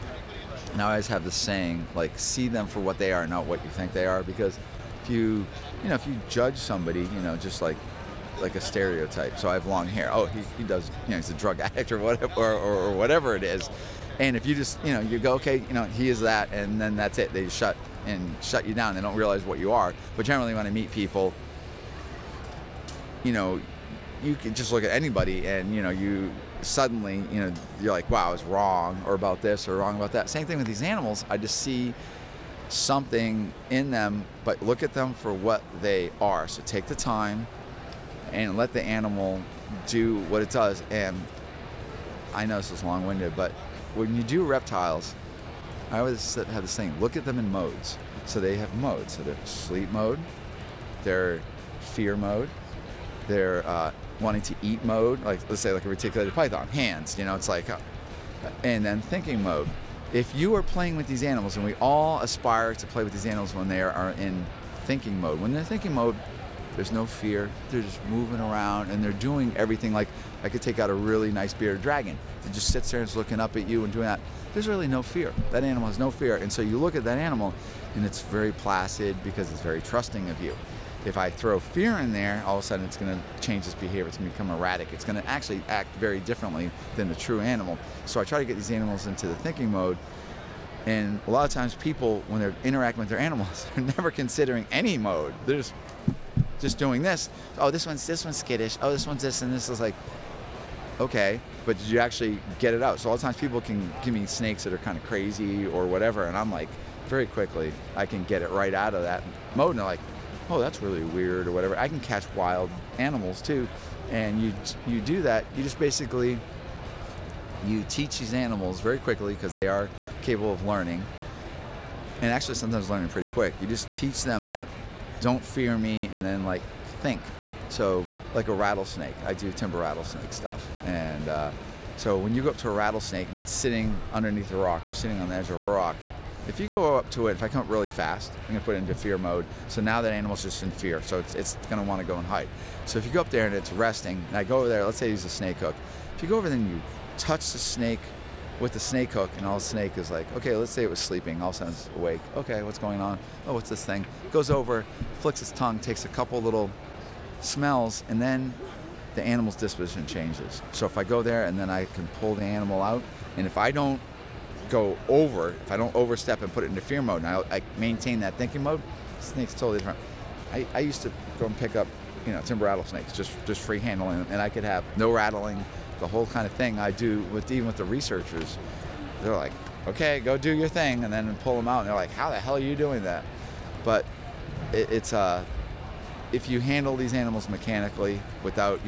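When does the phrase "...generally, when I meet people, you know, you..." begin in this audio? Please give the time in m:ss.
0:20.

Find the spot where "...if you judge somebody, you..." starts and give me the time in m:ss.
0:05.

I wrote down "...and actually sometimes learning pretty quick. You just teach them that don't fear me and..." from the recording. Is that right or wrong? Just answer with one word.
right.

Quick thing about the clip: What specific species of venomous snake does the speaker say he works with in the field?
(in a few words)
timber rattlesnake.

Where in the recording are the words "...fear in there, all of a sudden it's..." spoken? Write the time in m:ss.
1:21.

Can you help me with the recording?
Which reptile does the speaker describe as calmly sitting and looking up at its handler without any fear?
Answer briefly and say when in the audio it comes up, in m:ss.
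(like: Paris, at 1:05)
bearded dragon, at 1:11.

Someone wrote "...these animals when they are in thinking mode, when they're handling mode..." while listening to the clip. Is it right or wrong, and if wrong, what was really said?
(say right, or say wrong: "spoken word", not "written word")
wrong: "thinking", not "handling".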